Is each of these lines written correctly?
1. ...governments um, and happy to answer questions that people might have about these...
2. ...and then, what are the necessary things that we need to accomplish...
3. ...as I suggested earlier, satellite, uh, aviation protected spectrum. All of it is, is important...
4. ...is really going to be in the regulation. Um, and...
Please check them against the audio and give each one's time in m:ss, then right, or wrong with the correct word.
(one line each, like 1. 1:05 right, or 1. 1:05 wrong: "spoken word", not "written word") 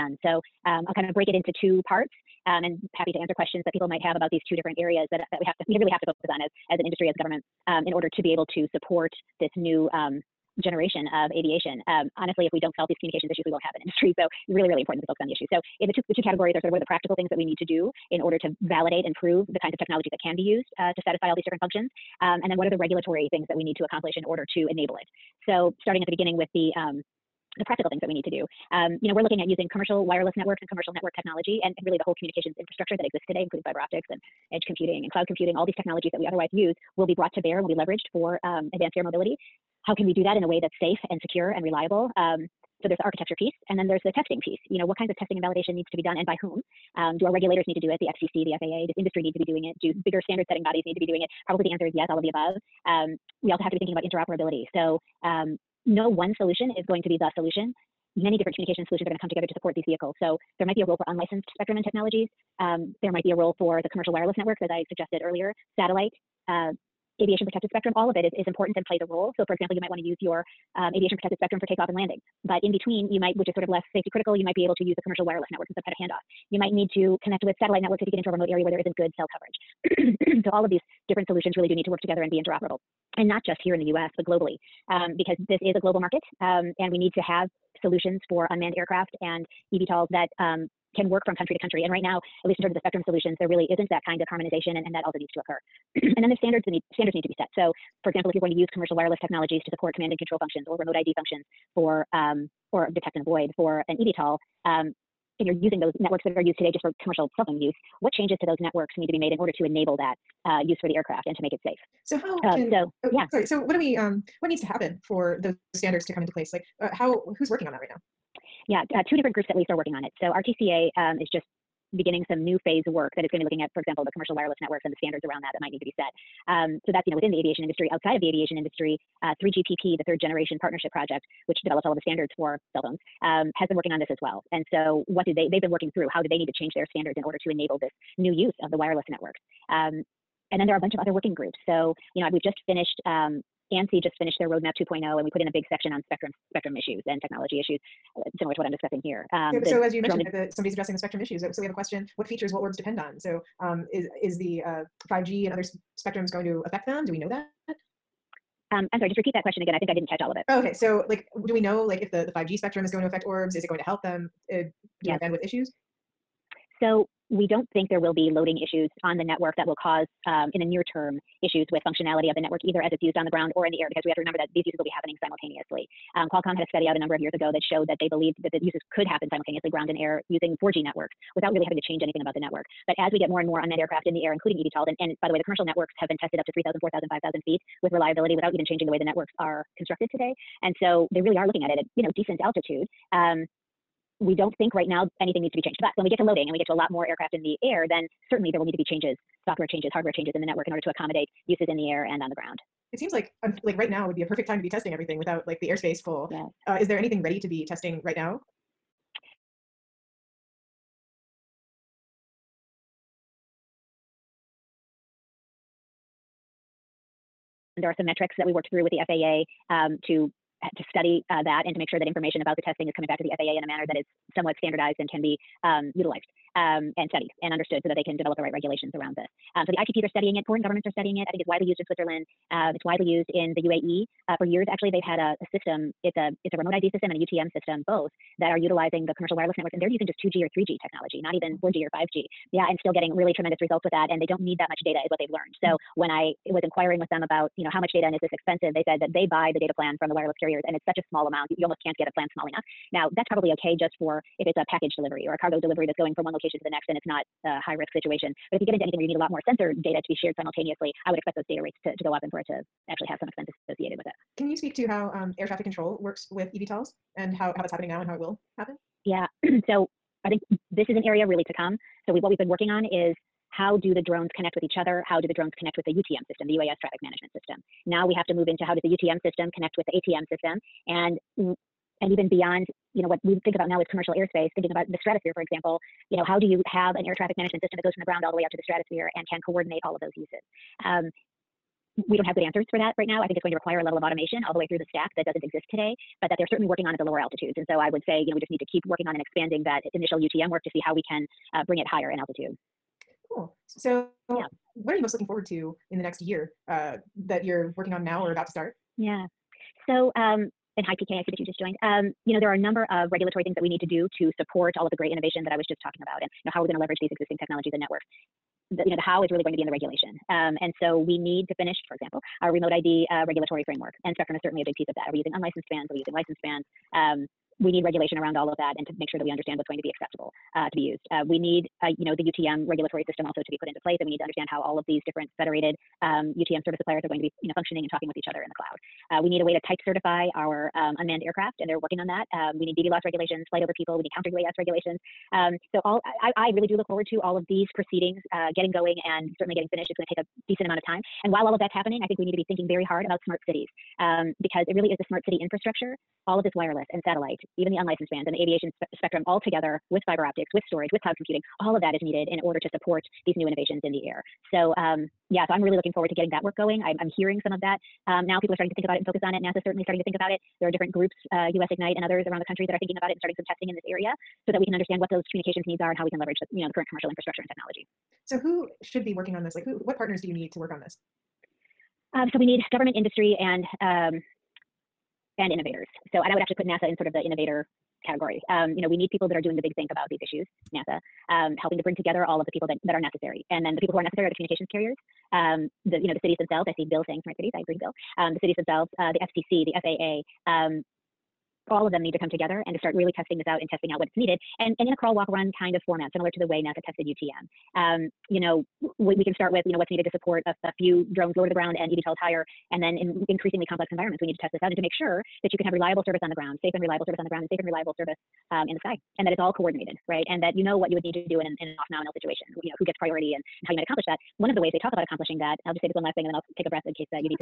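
1. 0:01 wrong: "parts", not "governments"
2. 0:22 wrong: "regulatory", not "necessary"
3. 1:04 right
4. 5:19 right.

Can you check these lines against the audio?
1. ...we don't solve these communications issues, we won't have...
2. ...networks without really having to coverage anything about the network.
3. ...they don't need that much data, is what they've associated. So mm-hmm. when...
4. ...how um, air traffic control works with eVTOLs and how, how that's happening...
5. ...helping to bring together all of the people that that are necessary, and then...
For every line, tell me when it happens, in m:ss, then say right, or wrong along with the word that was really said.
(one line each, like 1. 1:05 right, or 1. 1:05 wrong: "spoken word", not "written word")
1. 0:12 right
2. 3:00 wrong: "change", not "coverage"
3. 4:04 wrong: "learned", not "associated"
4. 4:24 right
5. 6:31 right.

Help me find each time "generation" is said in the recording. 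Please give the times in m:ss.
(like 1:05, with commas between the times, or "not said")
0:10, 2:10.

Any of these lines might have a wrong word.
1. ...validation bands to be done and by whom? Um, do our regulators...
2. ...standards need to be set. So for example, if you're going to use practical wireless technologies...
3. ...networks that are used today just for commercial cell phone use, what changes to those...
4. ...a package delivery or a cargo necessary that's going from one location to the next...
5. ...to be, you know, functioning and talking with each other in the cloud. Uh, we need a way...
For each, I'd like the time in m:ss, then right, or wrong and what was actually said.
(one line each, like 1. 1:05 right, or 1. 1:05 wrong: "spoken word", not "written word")
1. 0:45 wrong: "needs", not "bands"
2. 1:36 wrong: "commercial", not "practical"
3. 1:45 right
4. 4:14 wrong: "delivery", not "necessary"
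5. 5:37 right.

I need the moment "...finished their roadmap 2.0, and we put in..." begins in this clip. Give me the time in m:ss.
2:24.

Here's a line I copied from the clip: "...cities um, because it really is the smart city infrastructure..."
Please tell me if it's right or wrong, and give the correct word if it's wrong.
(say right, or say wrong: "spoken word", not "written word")
right.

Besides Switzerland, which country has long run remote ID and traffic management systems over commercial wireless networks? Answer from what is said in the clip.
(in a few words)
UAE.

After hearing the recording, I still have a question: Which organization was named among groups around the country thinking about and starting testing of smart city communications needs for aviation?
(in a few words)
US Ignite.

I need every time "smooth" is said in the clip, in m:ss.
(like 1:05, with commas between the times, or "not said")
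not said.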